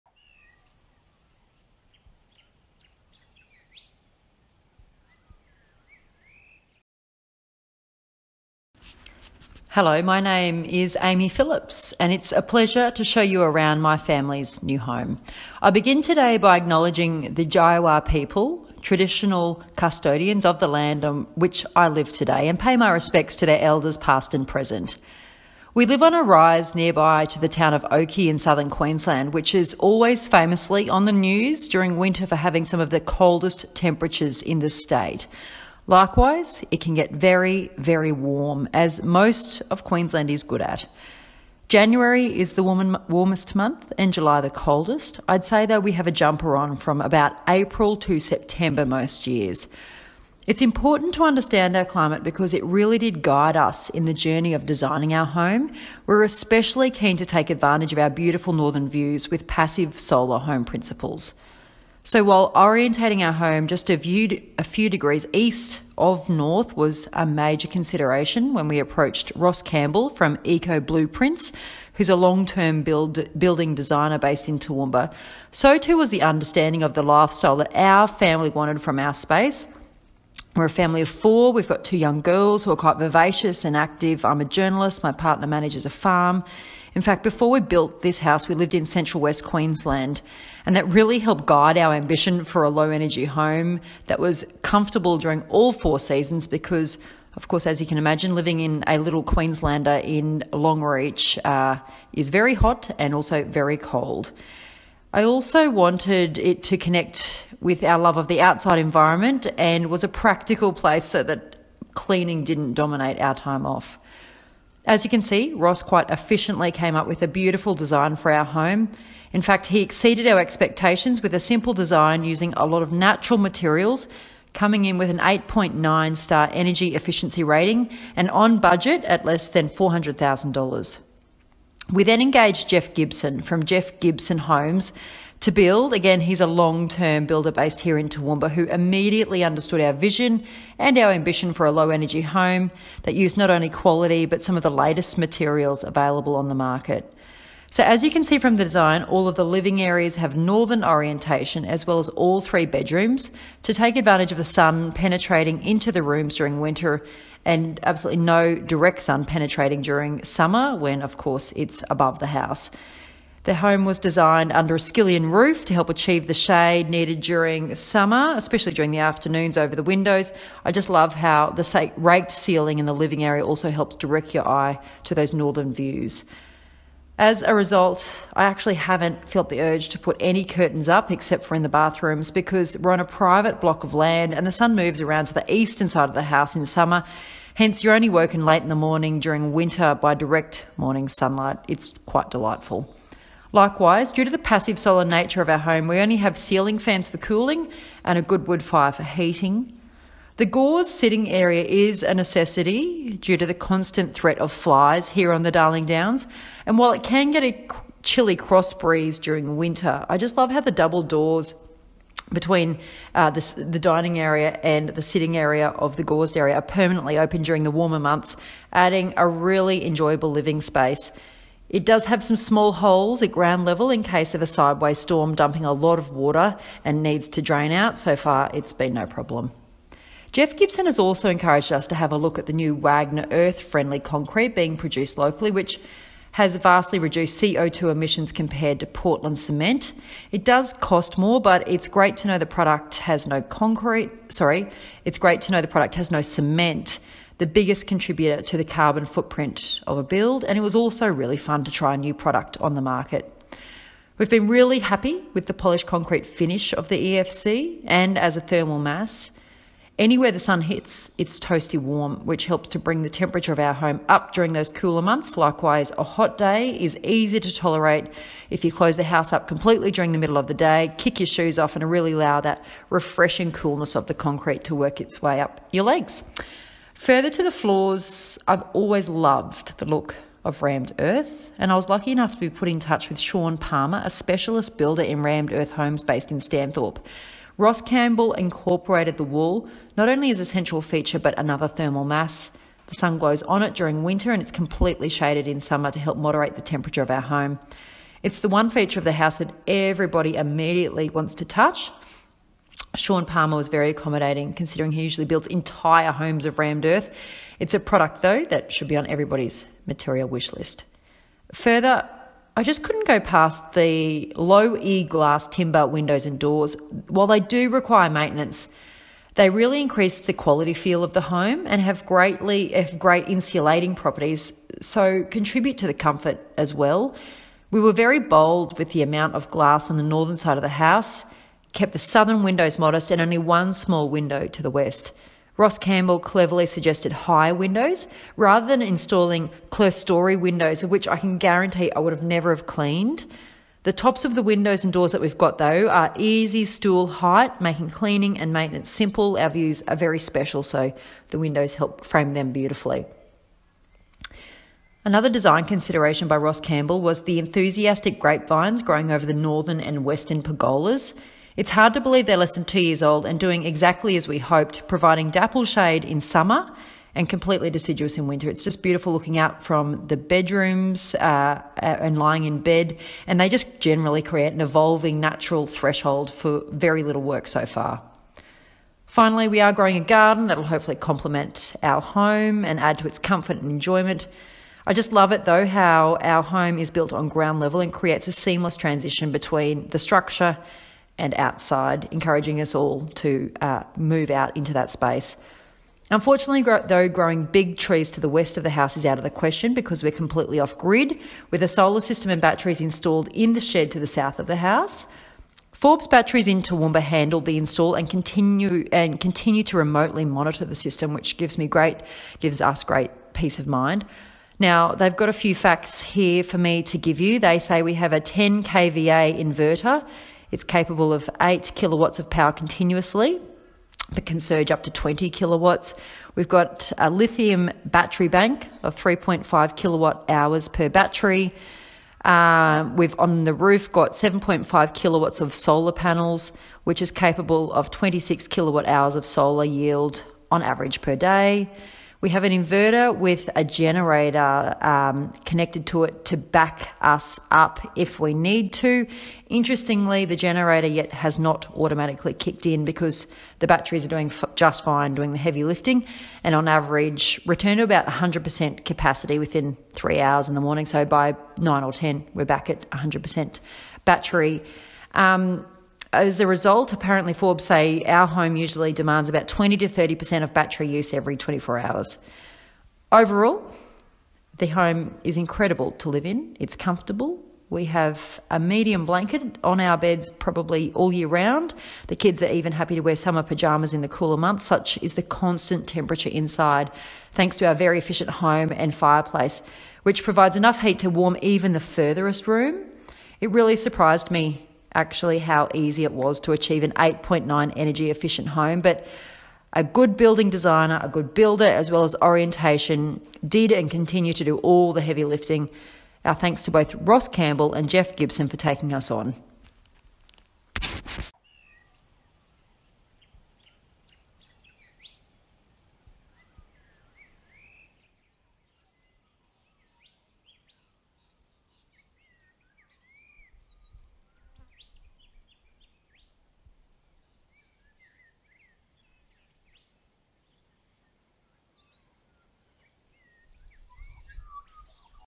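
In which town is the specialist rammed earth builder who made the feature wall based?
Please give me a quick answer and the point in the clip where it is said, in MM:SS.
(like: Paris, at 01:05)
Stanthorpe, at 04:46.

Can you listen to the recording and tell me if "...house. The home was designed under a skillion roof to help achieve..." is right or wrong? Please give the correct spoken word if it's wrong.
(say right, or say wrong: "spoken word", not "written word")
right.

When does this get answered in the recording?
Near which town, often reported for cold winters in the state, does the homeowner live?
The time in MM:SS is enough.
00:27.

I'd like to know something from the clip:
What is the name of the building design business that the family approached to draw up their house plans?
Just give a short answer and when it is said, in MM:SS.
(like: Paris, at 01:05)
Eco Blueprints, at 01:10.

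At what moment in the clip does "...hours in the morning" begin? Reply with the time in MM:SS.
07:40.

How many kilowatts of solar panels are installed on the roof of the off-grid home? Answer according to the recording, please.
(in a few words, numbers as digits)
7.5.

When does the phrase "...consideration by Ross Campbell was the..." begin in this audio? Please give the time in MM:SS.
05:55.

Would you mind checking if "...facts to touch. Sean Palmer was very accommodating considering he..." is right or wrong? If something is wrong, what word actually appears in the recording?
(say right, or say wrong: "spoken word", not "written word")
wrong: "wants", not "facts".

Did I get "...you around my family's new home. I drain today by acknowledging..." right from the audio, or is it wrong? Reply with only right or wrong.
wrong.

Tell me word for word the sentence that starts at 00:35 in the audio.
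Likewise, it can get very, very warm, as most of Queensland is good at.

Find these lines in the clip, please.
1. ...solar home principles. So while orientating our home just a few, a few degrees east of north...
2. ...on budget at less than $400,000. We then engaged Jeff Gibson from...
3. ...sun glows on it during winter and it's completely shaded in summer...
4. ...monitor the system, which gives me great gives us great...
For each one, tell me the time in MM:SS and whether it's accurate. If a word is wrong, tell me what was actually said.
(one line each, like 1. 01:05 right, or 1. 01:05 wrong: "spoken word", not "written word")
1. 00:59 right
2. 02:08 right
3. 04:52 right
4. 06:50 right.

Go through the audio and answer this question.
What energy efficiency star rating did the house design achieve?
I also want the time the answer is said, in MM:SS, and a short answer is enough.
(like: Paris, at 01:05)
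8.9, at 02:05.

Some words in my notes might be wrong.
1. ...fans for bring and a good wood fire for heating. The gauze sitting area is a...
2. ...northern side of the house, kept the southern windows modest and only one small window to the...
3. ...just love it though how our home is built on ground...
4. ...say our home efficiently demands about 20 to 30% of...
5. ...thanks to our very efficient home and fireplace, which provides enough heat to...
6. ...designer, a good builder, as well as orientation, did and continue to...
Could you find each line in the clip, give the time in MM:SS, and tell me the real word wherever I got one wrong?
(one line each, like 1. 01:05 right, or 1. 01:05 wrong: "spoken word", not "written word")
1. 03:16 wrong: "cooling", not "bring"
2. 05:30 right
3. 06:24 right
4. 07:47 wrong: "usually", not "efficiently"
5. 08:07 right
6. 08:20 right.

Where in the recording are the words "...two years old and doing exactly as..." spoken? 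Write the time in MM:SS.
06:02.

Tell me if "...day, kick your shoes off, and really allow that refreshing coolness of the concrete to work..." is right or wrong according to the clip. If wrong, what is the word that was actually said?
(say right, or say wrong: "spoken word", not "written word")
right.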